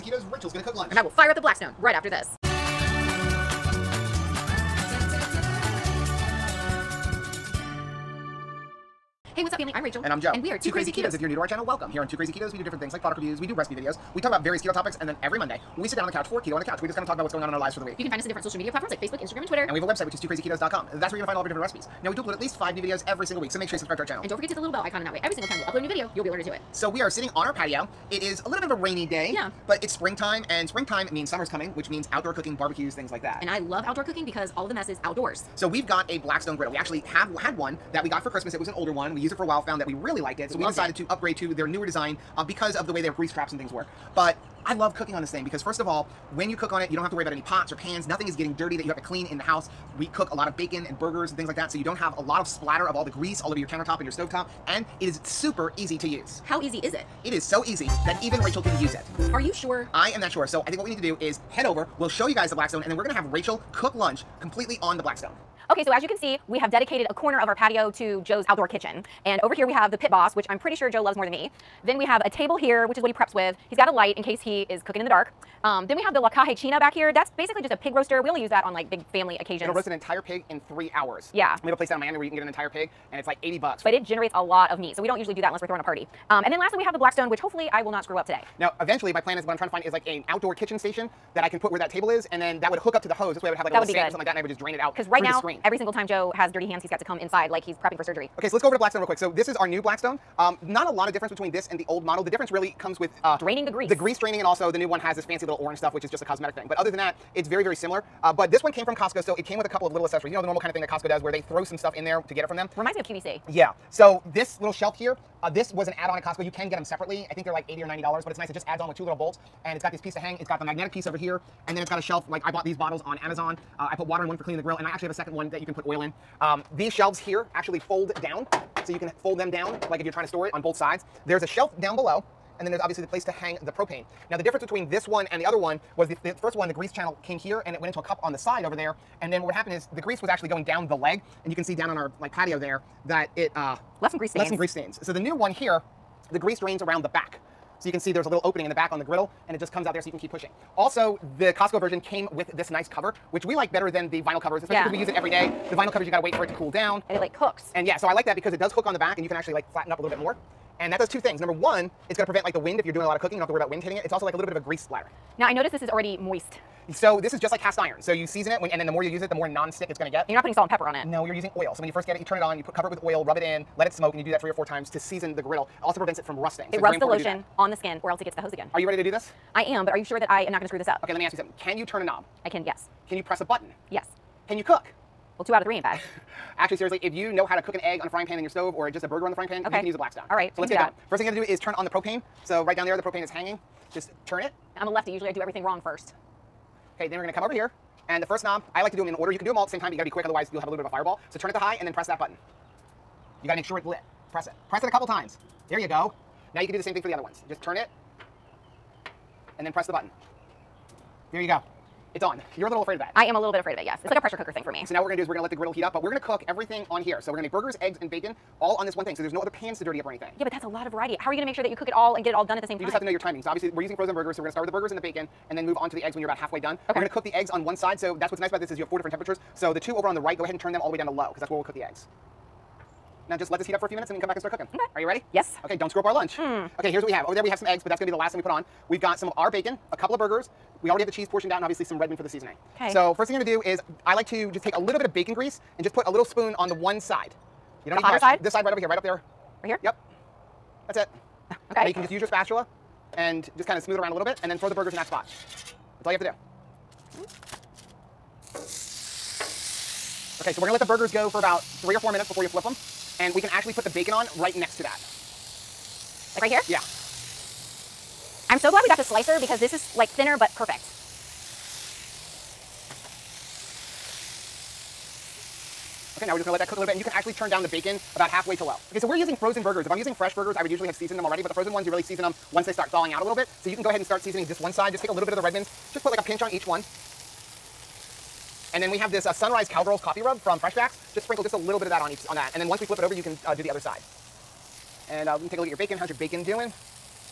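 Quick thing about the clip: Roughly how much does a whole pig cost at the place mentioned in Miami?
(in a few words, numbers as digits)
$80.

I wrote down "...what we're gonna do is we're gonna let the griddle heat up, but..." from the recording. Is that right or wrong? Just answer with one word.
right.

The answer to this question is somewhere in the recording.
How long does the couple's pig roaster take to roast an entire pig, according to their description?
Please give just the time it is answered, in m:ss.
1:20.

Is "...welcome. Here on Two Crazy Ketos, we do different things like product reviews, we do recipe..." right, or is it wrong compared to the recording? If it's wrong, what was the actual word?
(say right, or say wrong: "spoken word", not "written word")
right.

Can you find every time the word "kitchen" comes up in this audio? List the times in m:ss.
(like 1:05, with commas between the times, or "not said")
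1:08, 1:30.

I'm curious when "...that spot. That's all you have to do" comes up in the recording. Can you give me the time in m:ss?
4:14.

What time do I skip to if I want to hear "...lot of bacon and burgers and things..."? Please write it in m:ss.
0:50.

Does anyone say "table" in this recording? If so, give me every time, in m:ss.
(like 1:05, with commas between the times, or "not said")
1:12, 1:31.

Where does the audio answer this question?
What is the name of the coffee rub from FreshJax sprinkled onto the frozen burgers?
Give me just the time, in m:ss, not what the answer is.
4:49.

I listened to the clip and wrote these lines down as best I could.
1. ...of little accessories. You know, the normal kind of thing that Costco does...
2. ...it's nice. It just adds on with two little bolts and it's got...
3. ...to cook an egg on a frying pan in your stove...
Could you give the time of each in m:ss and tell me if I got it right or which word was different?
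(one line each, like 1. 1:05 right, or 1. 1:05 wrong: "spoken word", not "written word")
1. 1:49 right
2. 1:58 right
3. 3:07 right.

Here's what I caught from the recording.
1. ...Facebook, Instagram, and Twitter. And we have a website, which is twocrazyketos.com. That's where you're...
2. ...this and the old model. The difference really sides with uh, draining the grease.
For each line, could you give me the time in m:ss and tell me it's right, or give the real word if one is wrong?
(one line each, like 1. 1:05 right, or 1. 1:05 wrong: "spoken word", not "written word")
1. 0:19 right
2. 1:41 wrong: "comes", not "sides".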